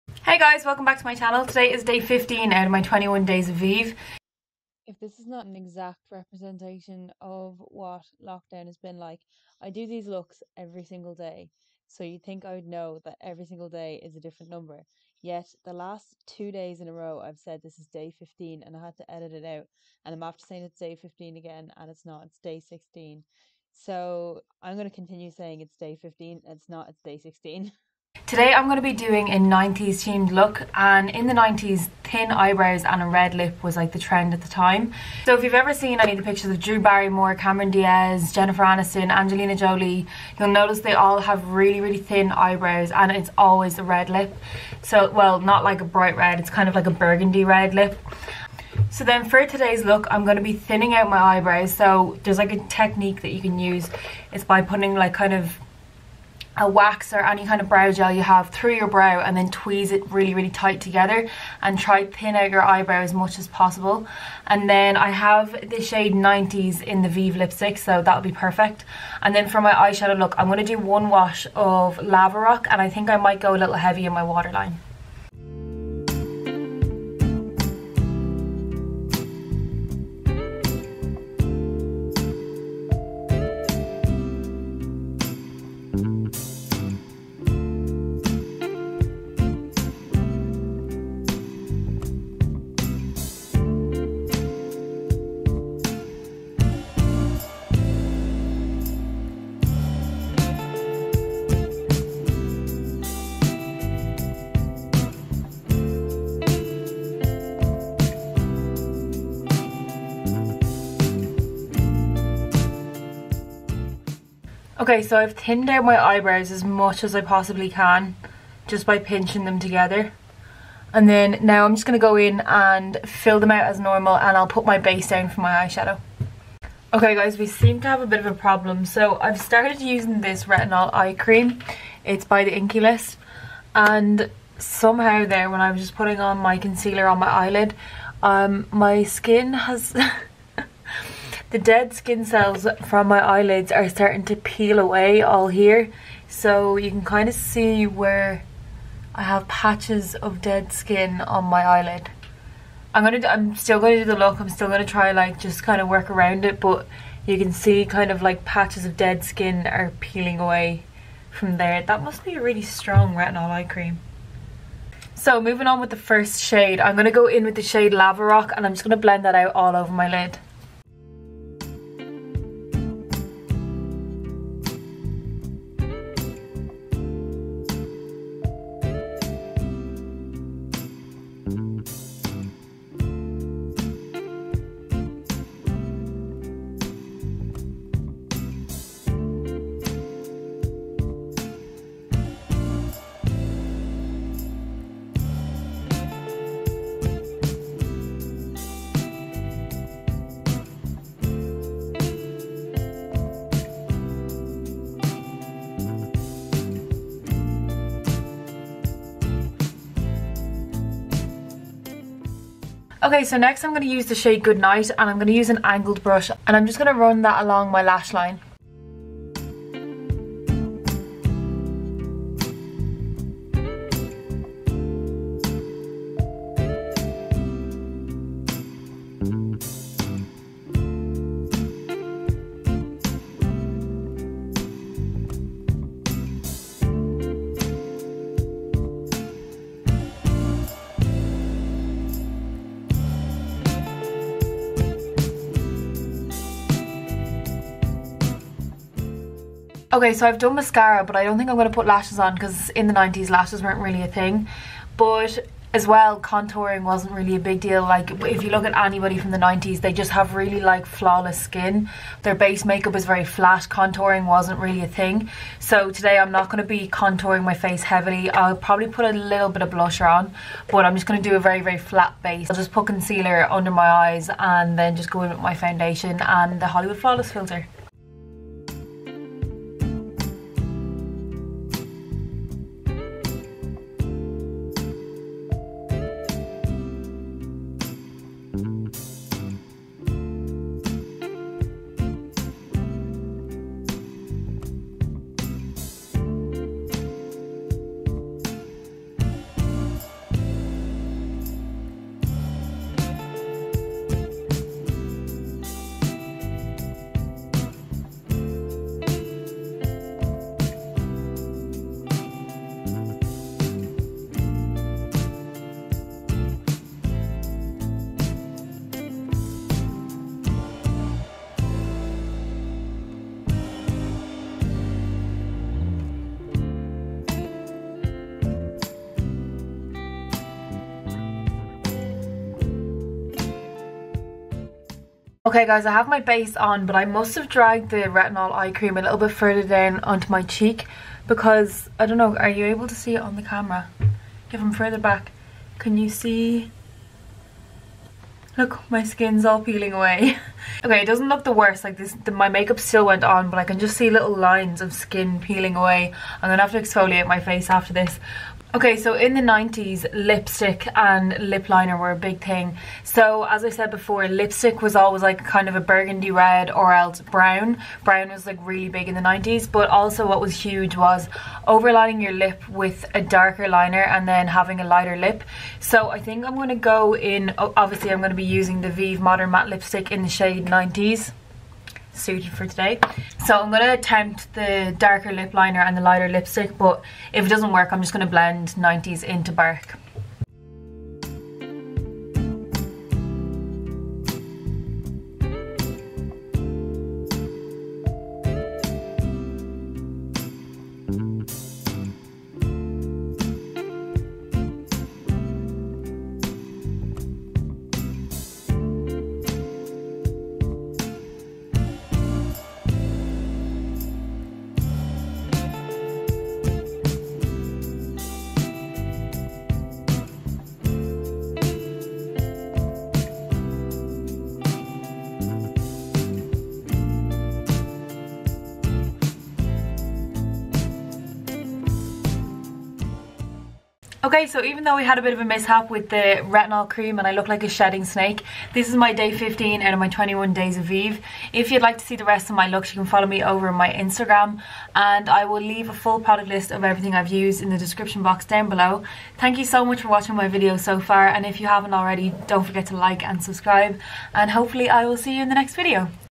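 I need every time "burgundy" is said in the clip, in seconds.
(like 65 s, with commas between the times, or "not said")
47 s, 365 s.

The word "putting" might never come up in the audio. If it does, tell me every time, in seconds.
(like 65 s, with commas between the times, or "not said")
54 s, 135 s.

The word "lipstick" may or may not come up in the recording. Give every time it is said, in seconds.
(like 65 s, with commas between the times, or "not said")
67 s, 360 s, 364 s, 379 s, 386 s.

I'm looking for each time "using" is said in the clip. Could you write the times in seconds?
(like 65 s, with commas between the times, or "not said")
129 s, 378 s.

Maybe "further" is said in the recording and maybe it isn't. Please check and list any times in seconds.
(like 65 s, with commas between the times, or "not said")
339 s, 344 s.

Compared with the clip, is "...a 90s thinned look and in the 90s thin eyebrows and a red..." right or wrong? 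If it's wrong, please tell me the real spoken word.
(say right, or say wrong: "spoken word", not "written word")
wrong: "themed", not "thinned".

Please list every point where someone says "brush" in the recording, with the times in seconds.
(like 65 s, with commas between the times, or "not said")
216 s.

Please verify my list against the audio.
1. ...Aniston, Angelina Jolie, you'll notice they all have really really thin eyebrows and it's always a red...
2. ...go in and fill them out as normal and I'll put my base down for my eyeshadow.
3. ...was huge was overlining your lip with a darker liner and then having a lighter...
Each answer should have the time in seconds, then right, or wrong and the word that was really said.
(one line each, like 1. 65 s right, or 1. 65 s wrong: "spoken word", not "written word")
1. 38 s right
2. 122 s right
3. 370 s right.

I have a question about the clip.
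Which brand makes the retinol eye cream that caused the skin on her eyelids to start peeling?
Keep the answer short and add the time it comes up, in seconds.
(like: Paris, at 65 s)
the Inkey List, at 132 s.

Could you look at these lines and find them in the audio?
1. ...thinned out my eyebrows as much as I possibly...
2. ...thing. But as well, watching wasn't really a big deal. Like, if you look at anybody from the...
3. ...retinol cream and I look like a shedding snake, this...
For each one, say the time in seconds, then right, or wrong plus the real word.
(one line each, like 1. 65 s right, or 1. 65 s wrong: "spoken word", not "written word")
1. 115 s right
2. 254 s wrong: "contouring", not "watching"
3. 436 s right.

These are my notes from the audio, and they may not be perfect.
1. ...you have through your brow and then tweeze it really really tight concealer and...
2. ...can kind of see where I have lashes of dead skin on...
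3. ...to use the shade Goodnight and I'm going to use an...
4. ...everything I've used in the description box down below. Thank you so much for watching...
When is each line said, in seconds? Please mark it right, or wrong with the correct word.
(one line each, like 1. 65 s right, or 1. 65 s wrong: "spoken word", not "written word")
1. 58 s wrong: "together", not "concealer"
2. 146 s wrong: "patches", not "lashes"
3. 213 s right
4. 446 s right.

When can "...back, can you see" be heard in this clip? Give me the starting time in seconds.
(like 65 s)
344 s.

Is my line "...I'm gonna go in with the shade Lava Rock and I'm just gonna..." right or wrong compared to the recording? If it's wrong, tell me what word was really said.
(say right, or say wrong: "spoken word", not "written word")
right.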